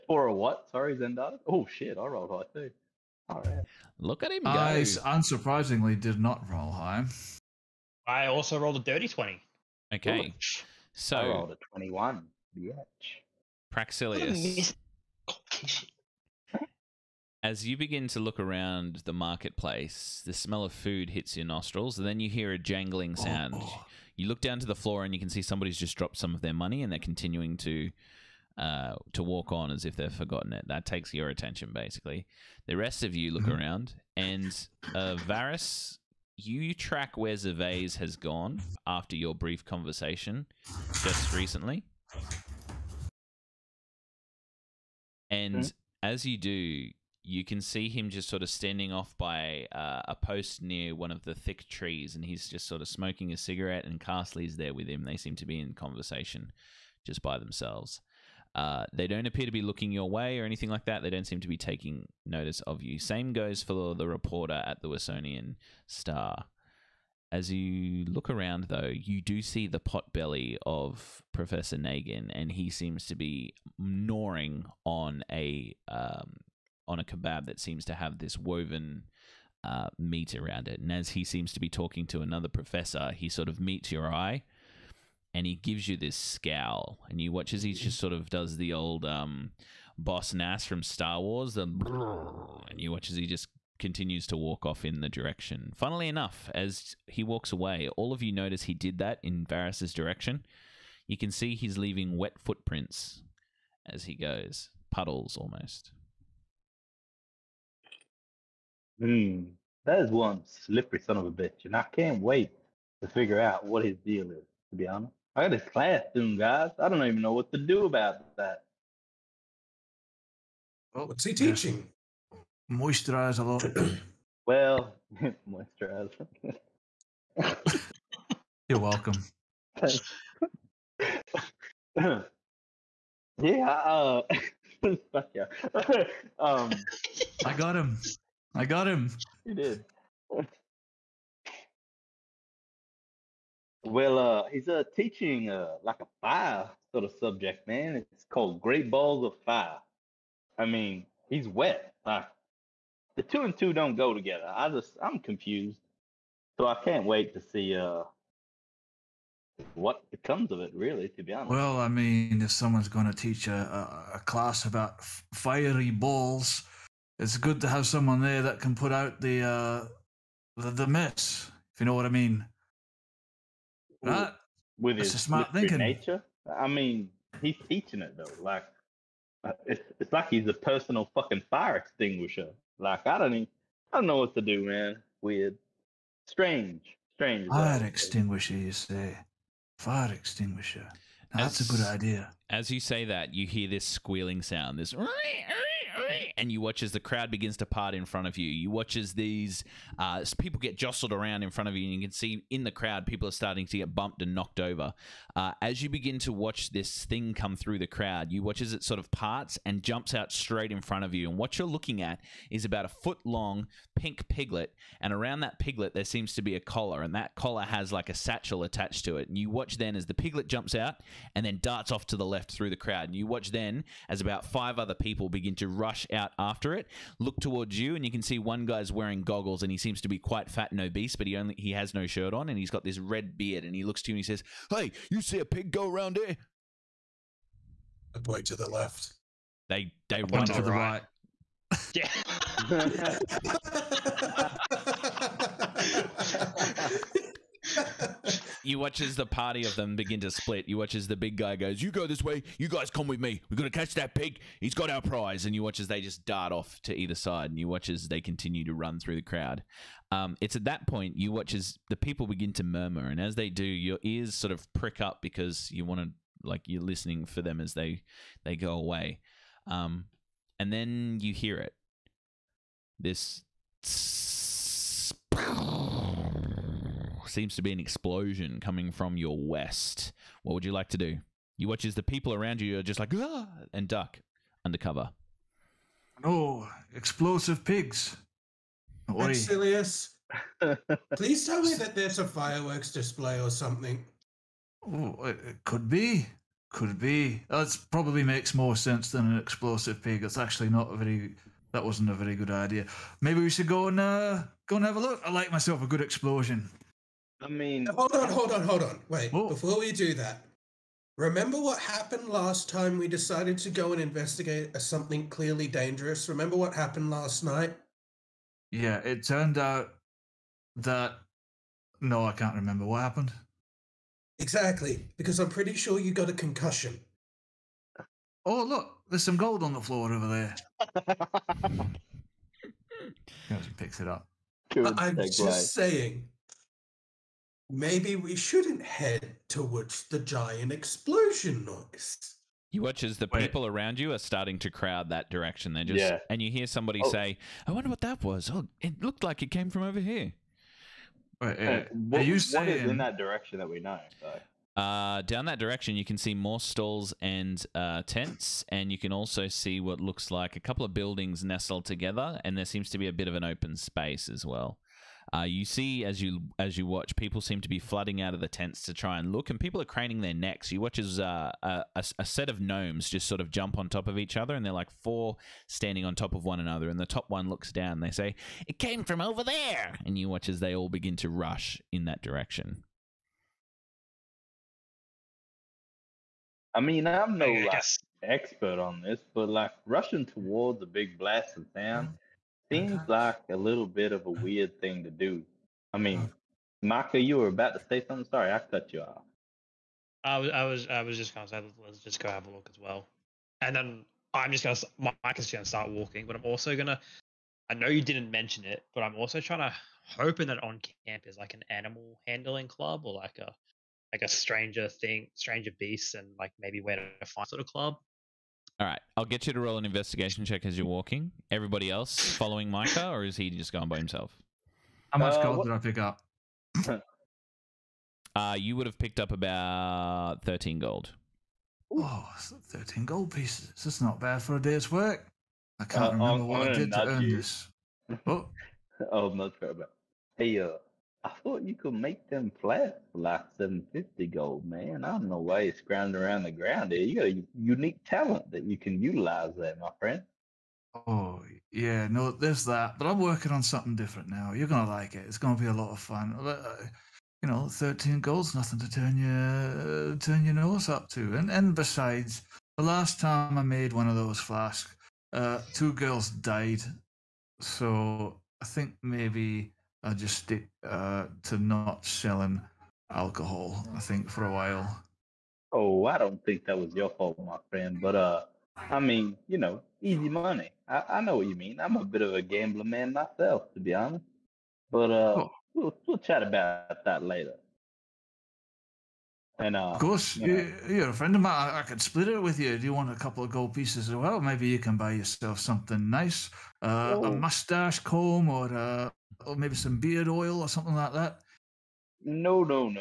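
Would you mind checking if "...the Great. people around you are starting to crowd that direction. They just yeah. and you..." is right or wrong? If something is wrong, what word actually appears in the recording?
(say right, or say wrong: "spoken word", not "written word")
wrong: "Wait", not "Great".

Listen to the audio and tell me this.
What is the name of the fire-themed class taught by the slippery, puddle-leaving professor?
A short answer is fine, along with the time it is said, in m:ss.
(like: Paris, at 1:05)
Great Balls of Fire, at 2:28.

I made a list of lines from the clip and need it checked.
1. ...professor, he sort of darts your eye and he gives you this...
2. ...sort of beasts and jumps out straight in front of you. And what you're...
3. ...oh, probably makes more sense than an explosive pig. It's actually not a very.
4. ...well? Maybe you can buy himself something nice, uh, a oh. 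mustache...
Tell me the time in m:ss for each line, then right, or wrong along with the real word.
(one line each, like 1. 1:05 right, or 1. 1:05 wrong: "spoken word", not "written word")
1. 1:22 wrong: "meets", not "darts"
2. 3:28 wrong: "parts", not "beasts"
3. 4:57 right
4. 8:14 wrong: "yourself", not "himself".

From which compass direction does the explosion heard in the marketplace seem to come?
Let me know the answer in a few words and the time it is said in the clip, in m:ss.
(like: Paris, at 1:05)
west, at 4:39.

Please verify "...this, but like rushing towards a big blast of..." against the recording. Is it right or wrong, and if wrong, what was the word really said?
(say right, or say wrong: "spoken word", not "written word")
right.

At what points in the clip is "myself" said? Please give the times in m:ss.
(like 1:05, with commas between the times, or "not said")
5:05, 8:03.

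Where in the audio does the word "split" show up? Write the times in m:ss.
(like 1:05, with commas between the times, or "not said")
4:10, 8:12.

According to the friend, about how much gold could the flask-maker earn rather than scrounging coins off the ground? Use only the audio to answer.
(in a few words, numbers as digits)
750 gold.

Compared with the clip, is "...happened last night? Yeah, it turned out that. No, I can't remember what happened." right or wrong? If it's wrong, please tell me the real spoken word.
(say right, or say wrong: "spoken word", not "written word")
right.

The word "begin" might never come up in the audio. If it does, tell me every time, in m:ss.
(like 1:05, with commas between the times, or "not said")
0:17, 3:17, 3:25, 3:45, 4:09, 4:22, 6:20.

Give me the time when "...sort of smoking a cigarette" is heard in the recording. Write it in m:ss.
0:52.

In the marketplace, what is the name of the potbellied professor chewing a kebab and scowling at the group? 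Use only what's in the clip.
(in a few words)
Professor Nagin.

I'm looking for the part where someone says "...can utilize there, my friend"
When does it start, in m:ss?
7:28.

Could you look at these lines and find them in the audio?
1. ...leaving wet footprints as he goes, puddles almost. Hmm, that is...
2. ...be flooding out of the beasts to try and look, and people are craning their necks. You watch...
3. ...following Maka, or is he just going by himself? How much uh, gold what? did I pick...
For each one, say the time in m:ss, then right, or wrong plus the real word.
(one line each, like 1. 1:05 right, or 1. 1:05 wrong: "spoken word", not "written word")
1. 1:41 right
2. 6:07 wrong: "tents", not "beasts"
3. 7:02 wrong: "Micah", not "Maka".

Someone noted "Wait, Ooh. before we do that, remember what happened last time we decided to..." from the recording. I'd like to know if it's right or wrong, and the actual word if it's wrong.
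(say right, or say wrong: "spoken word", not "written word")
right.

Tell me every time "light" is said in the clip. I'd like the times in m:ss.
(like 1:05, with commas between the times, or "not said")
not said.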